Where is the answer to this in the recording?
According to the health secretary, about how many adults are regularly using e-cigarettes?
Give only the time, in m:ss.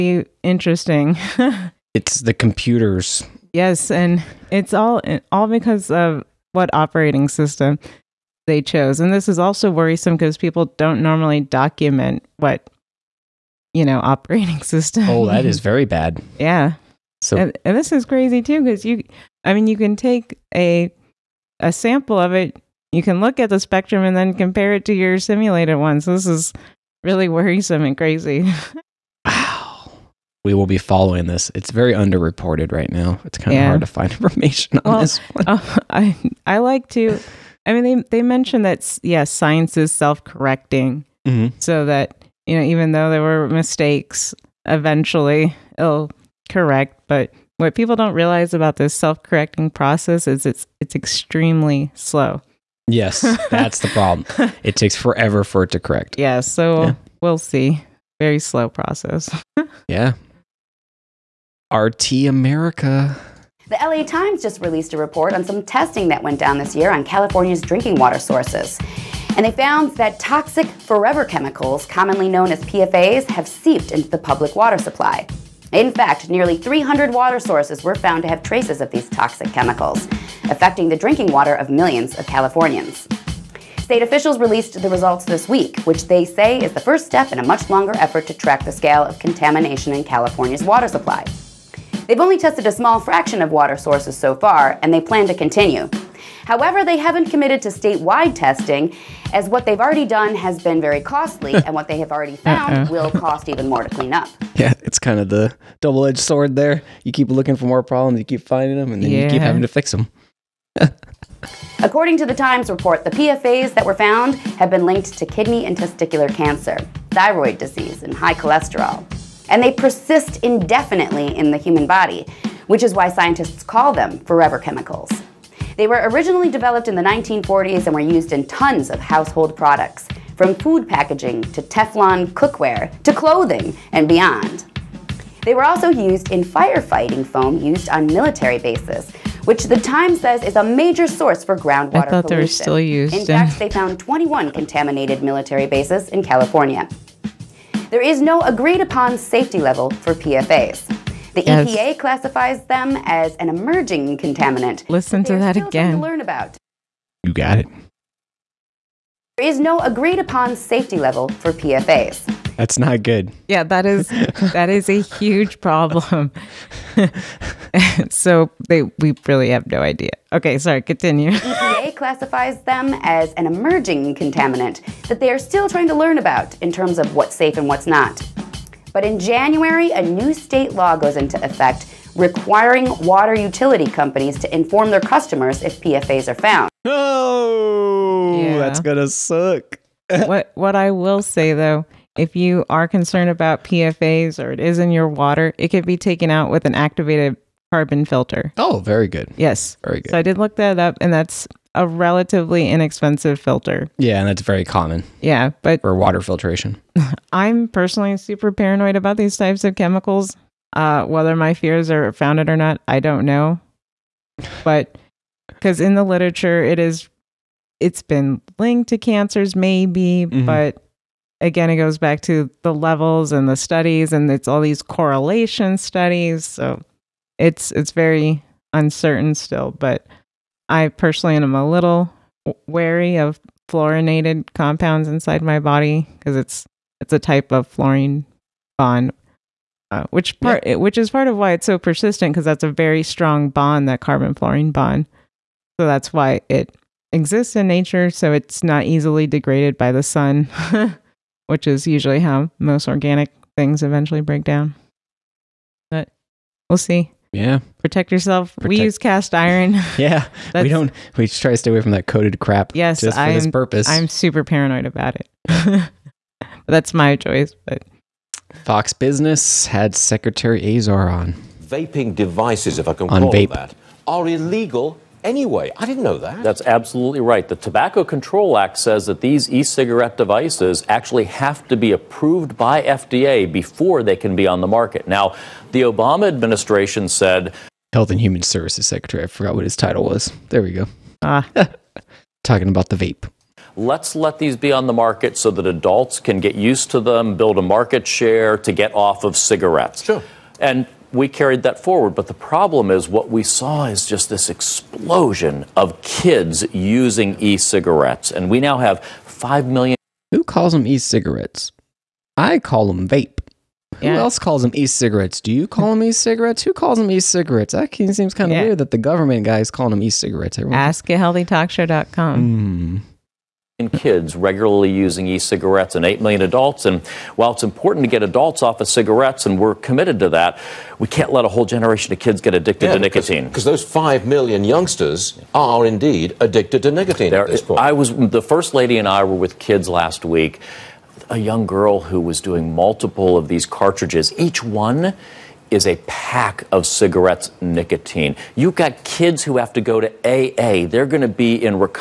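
5:26.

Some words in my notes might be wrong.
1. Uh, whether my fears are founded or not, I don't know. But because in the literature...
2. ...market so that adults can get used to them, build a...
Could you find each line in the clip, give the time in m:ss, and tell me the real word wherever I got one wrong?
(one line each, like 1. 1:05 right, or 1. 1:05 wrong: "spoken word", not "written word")
1. 3:30 right
2. 4:54 right.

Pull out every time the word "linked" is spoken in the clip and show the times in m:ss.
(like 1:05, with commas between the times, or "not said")
1:54, 3:38.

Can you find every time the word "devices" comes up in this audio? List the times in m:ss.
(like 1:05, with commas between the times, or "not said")
4:32, 4:40.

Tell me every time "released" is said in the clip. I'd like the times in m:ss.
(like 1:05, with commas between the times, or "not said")
1:04, 1:24.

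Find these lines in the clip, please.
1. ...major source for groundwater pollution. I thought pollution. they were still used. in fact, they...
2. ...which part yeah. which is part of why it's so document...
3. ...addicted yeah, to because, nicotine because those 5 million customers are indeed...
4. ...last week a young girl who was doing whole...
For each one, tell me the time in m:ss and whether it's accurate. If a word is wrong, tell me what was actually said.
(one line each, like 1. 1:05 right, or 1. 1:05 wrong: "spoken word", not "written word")
1. 2:20 right
2. 4:00 wrong: "persistent", not "document"
3. 5:32 wrong: "youngsters", not "customers"
4. 5:39 wrong: "multiple", not "whole".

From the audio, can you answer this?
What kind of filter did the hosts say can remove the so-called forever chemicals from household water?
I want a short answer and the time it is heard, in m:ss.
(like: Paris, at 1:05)
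activated carbon filter, at 3:16.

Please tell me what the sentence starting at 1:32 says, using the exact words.
They've only tested a small fraction of water sources so far, and they plan to continue.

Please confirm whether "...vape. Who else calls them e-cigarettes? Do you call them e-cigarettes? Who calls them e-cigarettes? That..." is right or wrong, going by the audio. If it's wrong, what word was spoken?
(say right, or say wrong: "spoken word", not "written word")
right.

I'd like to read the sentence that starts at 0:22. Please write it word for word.
You can look at the spectrum and then compare it to your simulated one.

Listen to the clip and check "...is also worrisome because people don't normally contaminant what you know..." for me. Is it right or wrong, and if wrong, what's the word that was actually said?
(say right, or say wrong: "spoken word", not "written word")
wrong: "document", not "contaminant".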